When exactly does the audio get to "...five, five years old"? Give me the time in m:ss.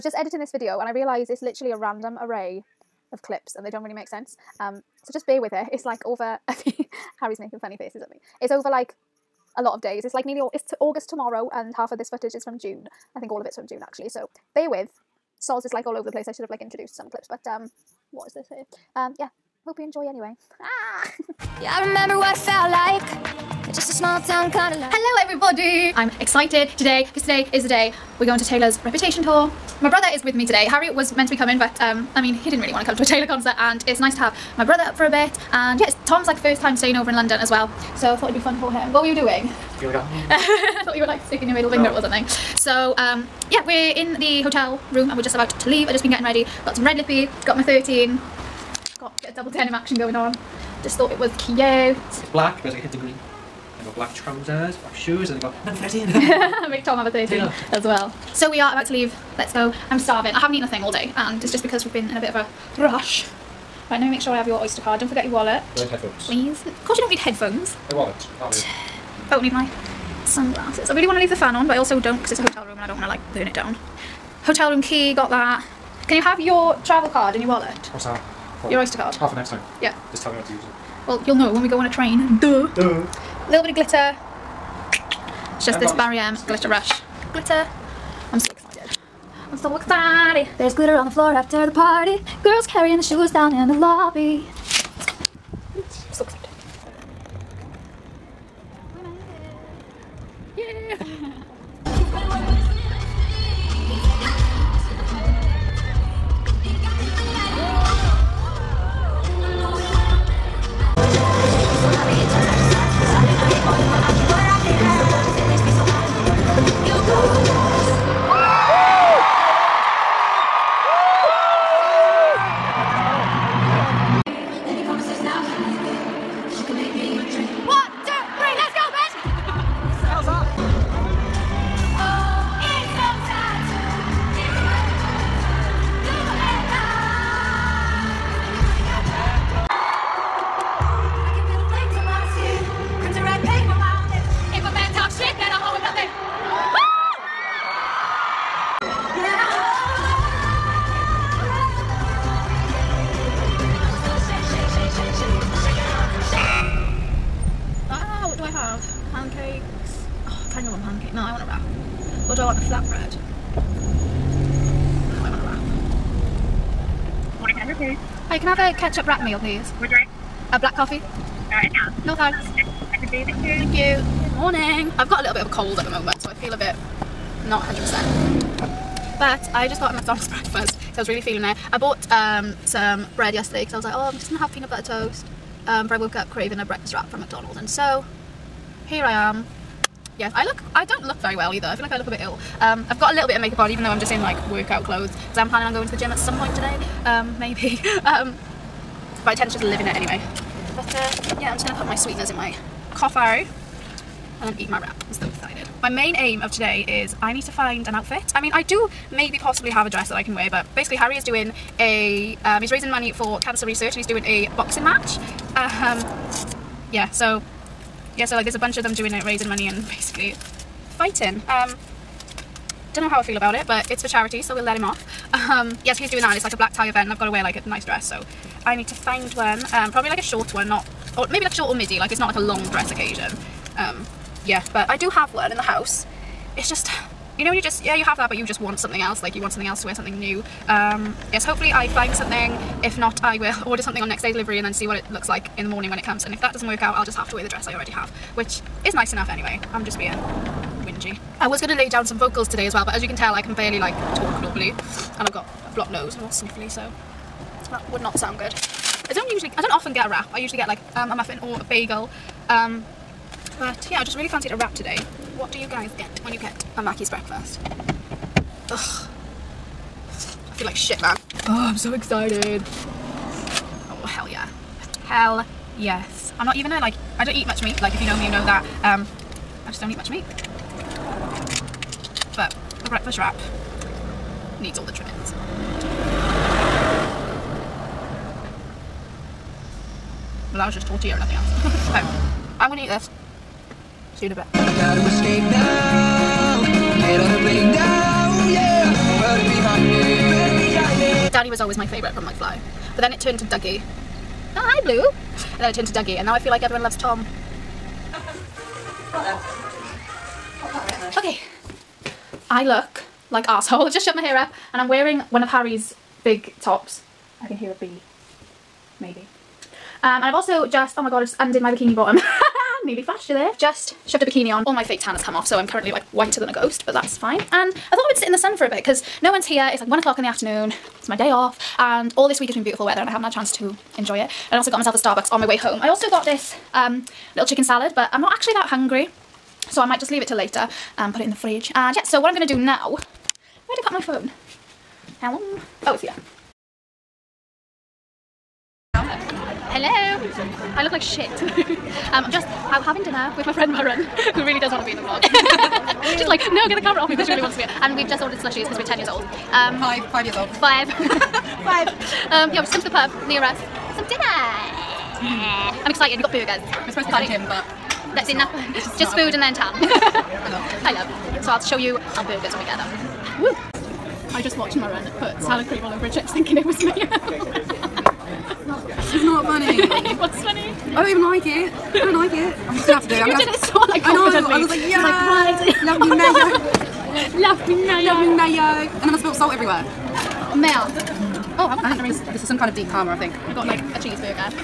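5:59.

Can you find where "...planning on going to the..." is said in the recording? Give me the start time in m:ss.
3:15.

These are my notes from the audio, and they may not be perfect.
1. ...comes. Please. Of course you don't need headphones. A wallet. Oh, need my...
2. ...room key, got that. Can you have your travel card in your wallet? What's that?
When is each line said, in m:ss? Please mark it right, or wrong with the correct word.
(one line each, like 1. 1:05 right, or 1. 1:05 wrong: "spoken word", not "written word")
1. 1:05 wrong: "headphones", not "comes"
2. 1:14 right.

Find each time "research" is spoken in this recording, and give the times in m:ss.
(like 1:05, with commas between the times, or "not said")
3:33.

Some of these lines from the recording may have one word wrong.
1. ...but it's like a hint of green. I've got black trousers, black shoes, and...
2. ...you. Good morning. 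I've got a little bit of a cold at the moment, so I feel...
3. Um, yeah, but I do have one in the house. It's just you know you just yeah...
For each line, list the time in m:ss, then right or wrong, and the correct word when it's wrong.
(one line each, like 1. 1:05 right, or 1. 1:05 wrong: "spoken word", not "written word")
1. 0:52 right
2. 2:53 right
3. 3:53 right.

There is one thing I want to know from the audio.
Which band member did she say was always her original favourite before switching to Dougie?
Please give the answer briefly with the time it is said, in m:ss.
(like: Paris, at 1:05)
Danny, at 5:01.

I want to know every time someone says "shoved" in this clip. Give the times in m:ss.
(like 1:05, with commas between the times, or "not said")
5:14, 5:24.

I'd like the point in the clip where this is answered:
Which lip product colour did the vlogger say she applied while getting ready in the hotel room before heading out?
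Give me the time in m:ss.
0:46.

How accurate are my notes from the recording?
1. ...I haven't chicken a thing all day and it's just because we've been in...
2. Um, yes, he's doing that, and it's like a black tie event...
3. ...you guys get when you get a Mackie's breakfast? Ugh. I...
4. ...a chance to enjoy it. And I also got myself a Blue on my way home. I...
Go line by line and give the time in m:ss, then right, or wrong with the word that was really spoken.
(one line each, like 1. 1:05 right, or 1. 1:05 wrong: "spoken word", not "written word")
1. 1:00 wrong: "eaten", not "chicken"
2. 3:45 right
3. 4:25 right
4. 5:33 wrong: "Starbucks", not "Blue".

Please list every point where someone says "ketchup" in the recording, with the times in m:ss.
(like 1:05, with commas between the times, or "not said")
2:48.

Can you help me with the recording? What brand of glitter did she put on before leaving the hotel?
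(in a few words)
Barry M.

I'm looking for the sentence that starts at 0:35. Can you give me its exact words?
And yeah, it's Tom's like first time staying over in London as well, so I thought it'd be fun for him.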